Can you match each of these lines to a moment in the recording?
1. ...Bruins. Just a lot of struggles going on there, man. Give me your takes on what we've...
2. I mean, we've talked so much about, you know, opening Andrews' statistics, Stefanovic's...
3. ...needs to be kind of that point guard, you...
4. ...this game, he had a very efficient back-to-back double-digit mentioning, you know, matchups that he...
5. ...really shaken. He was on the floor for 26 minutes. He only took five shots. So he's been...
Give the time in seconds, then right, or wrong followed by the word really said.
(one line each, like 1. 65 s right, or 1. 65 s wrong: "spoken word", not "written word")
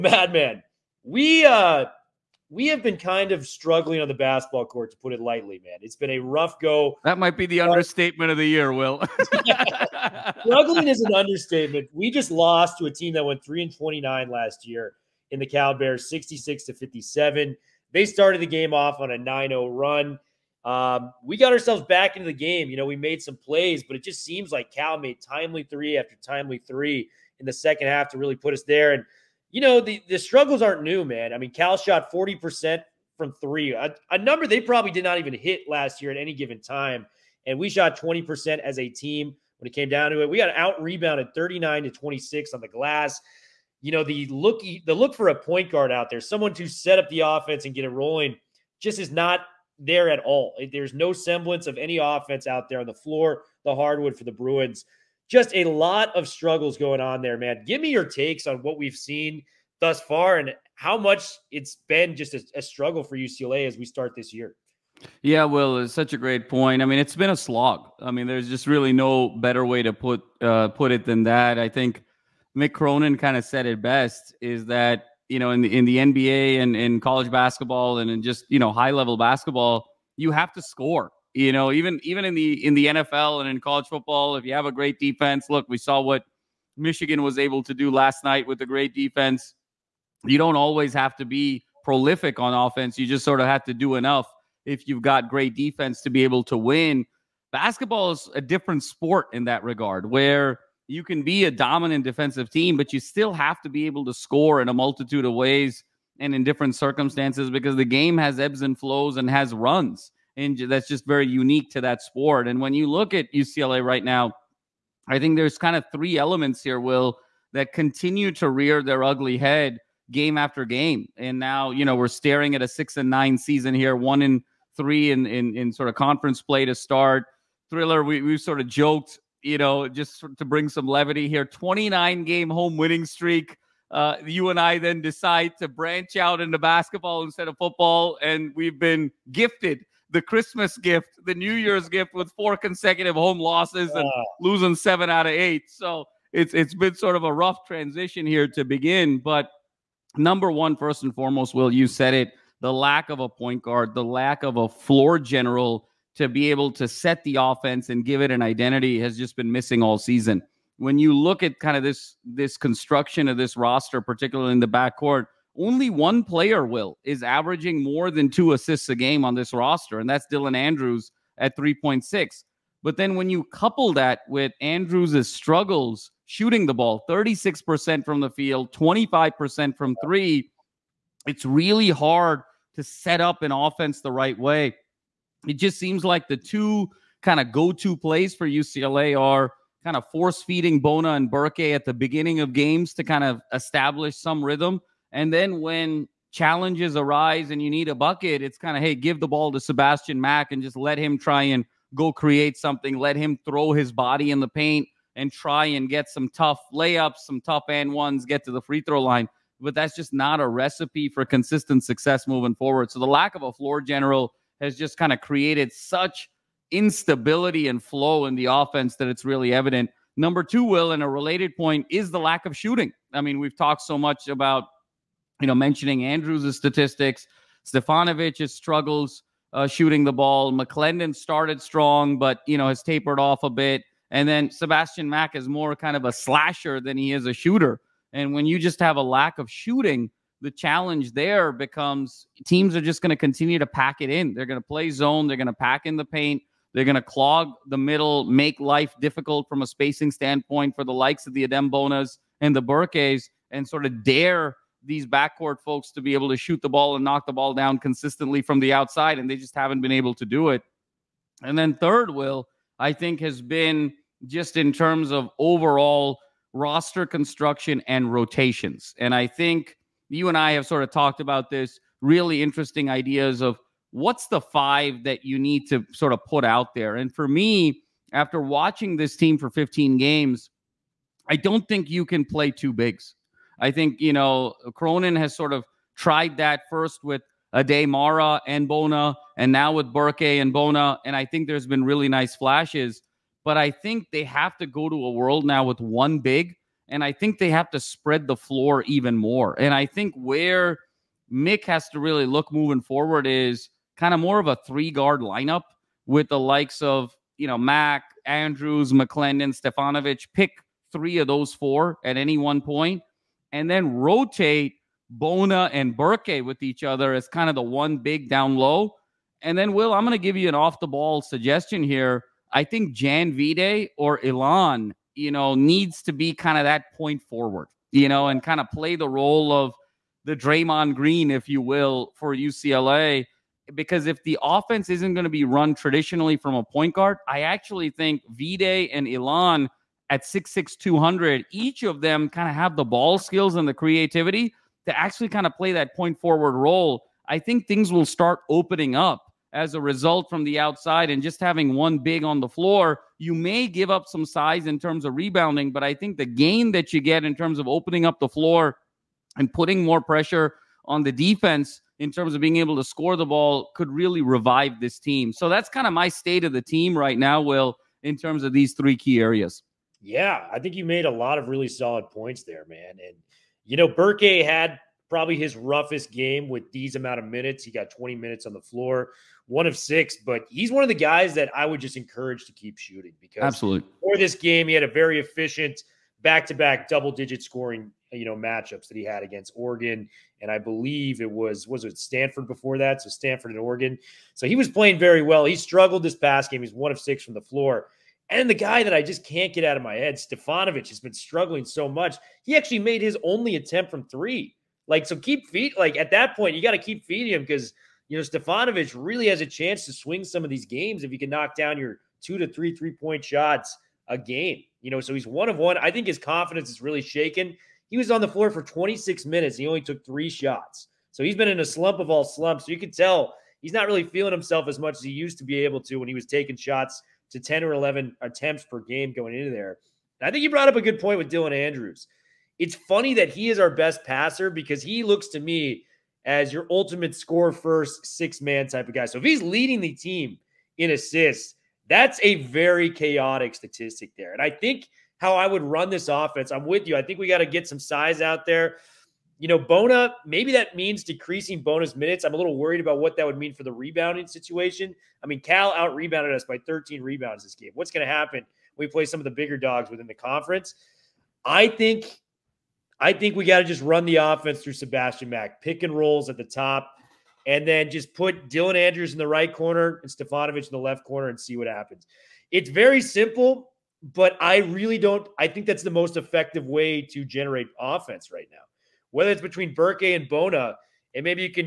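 1. 54 s right
2. 223 s wrong: "mentioning", not "opening"
3. 325 s wrong: "forward", not "guard"
4. 384 s wrong: "scoring", not "mentioning"
5. 416 s wrong: "three", not "five".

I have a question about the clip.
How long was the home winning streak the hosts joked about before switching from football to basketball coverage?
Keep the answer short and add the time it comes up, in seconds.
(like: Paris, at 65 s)
29 games, at 131 s.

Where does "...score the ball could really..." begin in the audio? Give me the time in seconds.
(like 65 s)
362 s.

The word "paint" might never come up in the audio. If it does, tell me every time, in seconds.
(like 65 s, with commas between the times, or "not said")
204 s, 246 s.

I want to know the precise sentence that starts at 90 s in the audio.
You don't always have to be prolific on offense.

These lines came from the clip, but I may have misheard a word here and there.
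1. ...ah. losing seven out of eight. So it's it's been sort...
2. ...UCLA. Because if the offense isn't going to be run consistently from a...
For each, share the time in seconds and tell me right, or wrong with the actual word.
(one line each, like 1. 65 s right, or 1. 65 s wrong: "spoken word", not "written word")
1. 144 s right
2. 332 s wrong: "traditionally", not "consistently".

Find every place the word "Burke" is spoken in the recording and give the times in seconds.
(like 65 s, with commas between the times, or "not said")
191 s, 252 s, 289 s, 315 s, 373 s, 479 s.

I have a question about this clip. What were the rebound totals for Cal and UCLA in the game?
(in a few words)
39 to 26.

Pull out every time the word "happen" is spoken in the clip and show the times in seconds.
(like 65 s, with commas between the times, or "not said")
458 s, 471 s.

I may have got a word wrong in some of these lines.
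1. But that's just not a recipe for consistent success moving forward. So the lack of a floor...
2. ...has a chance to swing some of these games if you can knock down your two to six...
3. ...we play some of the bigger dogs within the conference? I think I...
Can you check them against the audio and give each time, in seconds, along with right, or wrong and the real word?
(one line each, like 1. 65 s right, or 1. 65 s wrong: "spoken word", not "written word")
1. 209 s right
2. 409 s wrong: "three", not "six"
3. 458 s right.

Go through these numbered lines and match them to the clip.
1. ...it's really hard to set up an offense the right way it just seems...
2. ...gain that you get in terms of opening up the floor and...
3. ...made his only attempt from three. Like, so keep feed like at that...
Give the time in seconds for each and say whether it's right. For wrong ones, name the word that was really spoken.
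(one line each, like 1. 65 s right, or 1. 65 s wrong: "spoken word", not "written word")
1. 181 s right
2. 356 s right
3. 402 s right.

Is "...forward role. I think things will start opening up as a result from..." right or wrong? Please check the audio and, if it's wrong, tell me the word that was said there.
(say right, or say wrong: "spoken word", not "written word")
right.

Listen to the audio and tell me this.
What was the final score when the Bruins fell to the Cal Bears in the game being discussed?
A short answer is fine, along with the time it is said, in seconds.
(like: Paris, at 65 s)
66 to 57, at 16 s.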